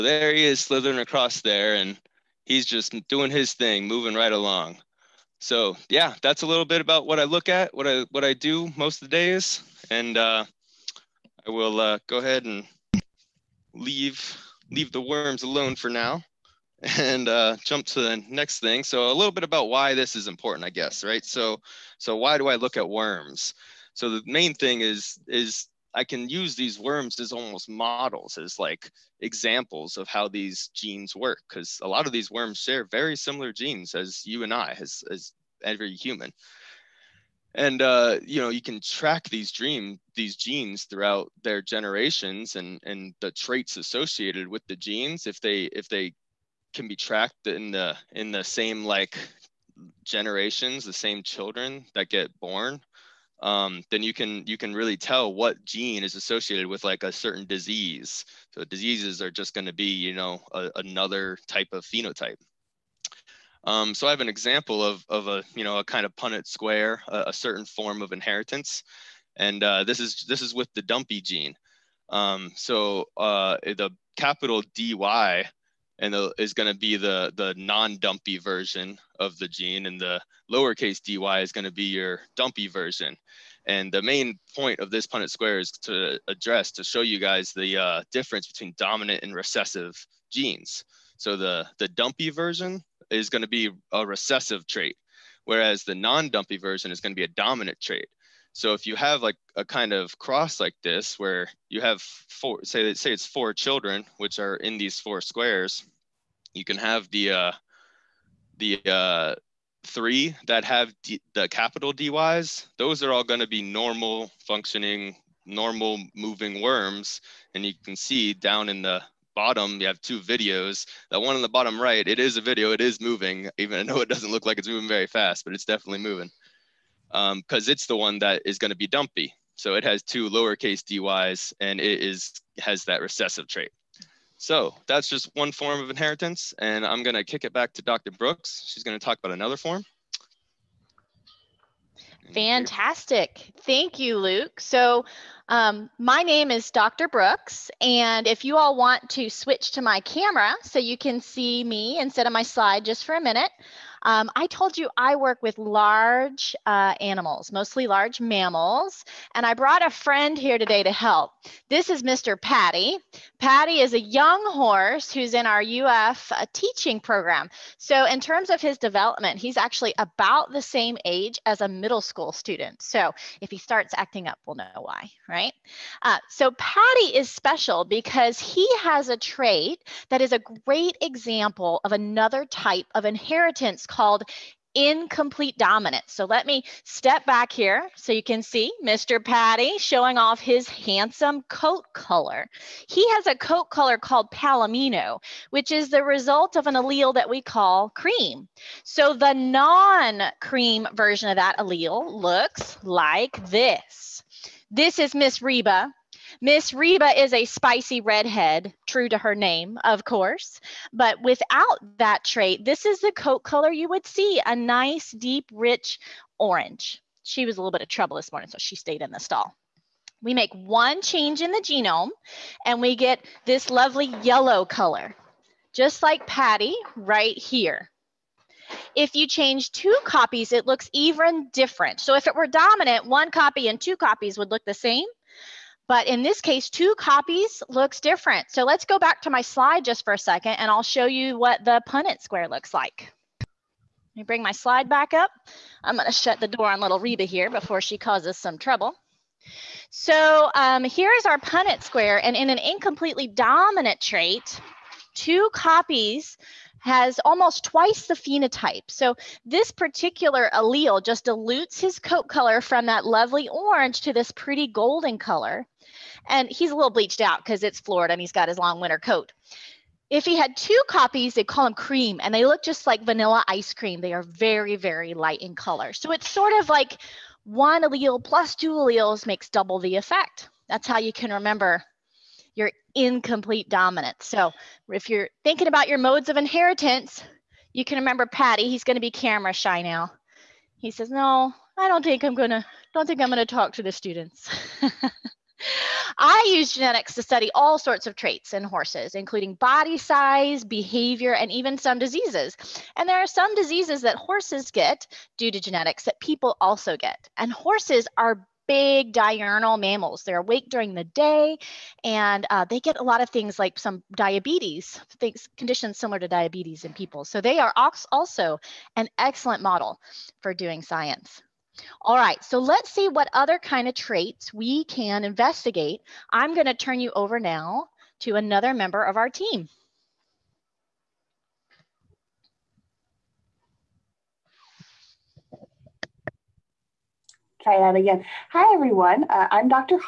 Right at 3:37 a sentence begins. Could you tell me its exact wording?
She was a little bit of trouble this morning, so she stayed in the stall.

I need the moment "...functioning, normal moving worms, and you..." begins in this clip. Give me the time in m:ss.
1:54.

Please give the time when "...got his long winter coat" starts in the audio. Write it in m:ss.
4:28.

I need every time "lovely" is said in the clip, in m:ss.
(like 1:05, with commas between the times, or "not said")
3:43, 4:23.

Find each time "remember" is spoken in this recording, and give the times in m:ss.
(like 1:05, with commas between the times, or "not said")
4:41, 4:47.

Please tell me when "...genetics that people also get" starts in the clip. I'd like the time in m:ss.
5:05.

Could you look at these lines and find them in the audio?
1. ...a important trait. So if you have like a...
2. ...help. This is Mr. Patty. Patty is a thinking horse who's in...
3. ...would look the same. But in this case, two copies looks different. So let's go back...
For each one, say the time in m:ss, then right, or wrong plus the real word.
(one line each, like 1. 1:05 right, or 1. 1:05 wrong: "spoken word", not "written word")
1. 1:37 wrong: "dominant", not "important"
2. 2:40 wrong: "young", not "thinking"
3. 3:54 right.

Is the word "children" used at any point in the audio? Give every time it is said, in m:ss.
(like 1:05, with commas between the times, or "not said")
0:51, 1:43.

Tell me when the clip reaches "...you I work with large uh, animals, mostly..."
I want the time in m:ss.
2:34.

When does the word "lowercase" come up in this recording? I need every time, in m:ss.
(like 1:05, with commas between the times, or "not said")
1:20, 2:10.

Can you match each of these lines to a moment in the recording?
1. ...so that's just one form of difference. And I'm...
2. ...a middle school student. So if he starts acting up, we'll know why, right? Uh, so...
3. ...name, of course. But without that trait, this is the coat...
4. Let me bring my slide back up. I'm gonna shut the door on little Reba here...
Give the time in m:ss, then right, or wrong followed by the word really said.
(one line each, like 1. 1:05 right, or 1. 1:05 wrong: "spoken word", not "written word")
1. 2:14 wrong: "inheritance", not "difference"
2. 2:51 right
3. 3:29 right
4. 4:03 right.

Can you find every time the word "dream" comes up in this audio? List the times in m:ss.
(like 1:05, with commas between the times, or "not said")
0:39.